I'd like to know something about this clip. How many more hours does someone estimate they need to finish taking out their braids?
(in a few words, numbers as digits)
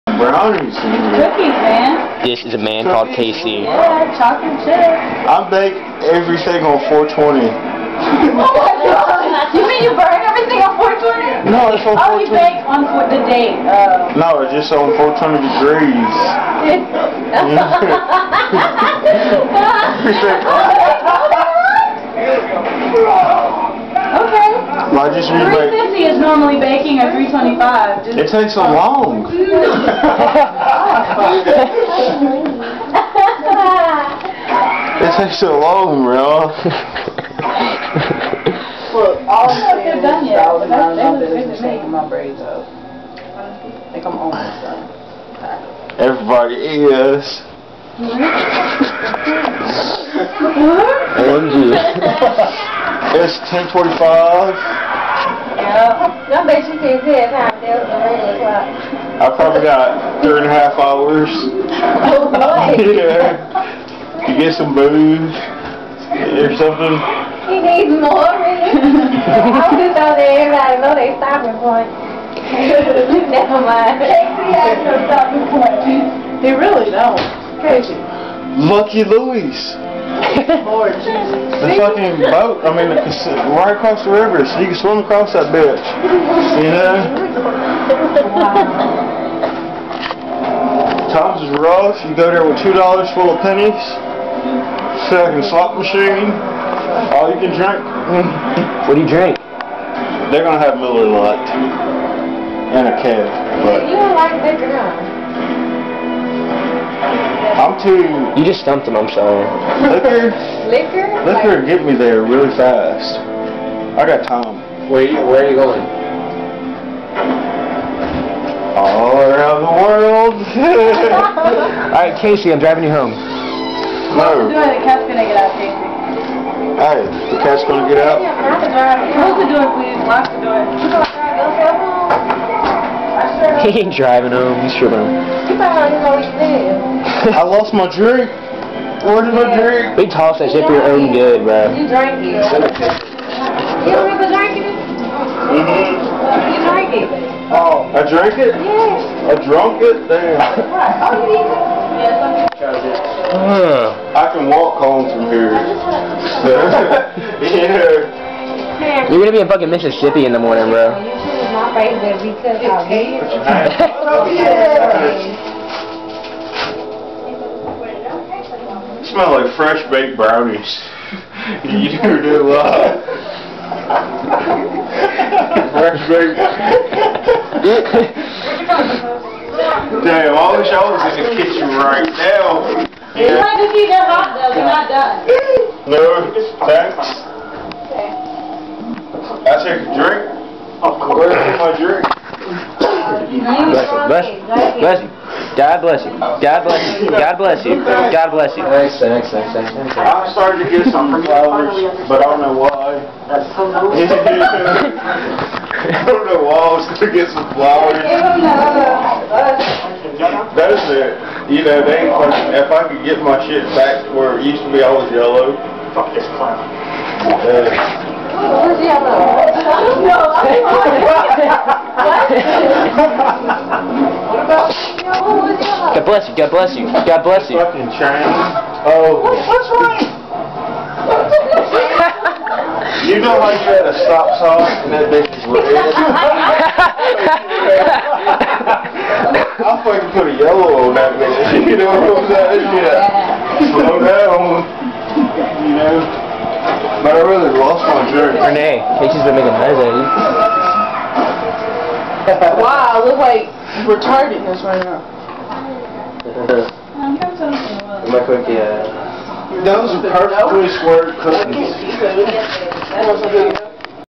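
3.5 hours.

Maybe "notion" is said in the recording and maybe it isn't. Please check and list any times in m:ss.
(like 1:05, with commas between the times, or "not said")
not said.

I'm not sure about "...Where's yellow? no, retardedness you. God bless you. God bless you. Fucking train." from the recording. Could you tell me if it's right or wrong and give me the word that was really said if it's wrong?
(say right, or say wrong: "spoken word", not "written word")
wrong: "bless", not "retardedness".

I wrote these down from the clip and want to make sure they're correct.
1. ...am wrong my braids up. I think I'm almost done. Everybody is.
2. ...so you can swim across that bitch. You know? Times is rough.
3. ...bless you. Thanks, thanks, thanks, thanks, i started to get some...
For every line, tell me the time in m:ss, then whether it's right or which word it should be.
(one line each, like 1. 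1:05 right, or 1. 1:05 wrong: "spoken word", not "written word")
1. 0:41 wrong: "taking", not "wrong"
2. 1:24 right
3. 3:18 right.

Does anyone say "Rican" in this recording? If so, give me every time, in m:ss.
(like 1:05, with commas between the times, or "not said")
not said.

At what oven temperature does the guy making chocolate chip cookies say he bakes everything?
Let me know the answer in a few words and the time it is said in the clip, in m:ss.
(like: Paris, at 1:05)
420 degrees, at 0:14.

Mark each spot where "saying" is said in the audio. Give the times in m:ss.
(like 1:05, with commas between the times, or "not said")
4:02.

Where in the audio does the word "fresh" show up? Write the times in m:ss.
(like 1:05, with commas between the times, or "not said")
2:49, 2:55.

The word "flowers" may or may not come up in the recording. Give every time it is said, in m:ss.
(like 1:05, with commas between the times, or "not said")
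3:21, 3:27.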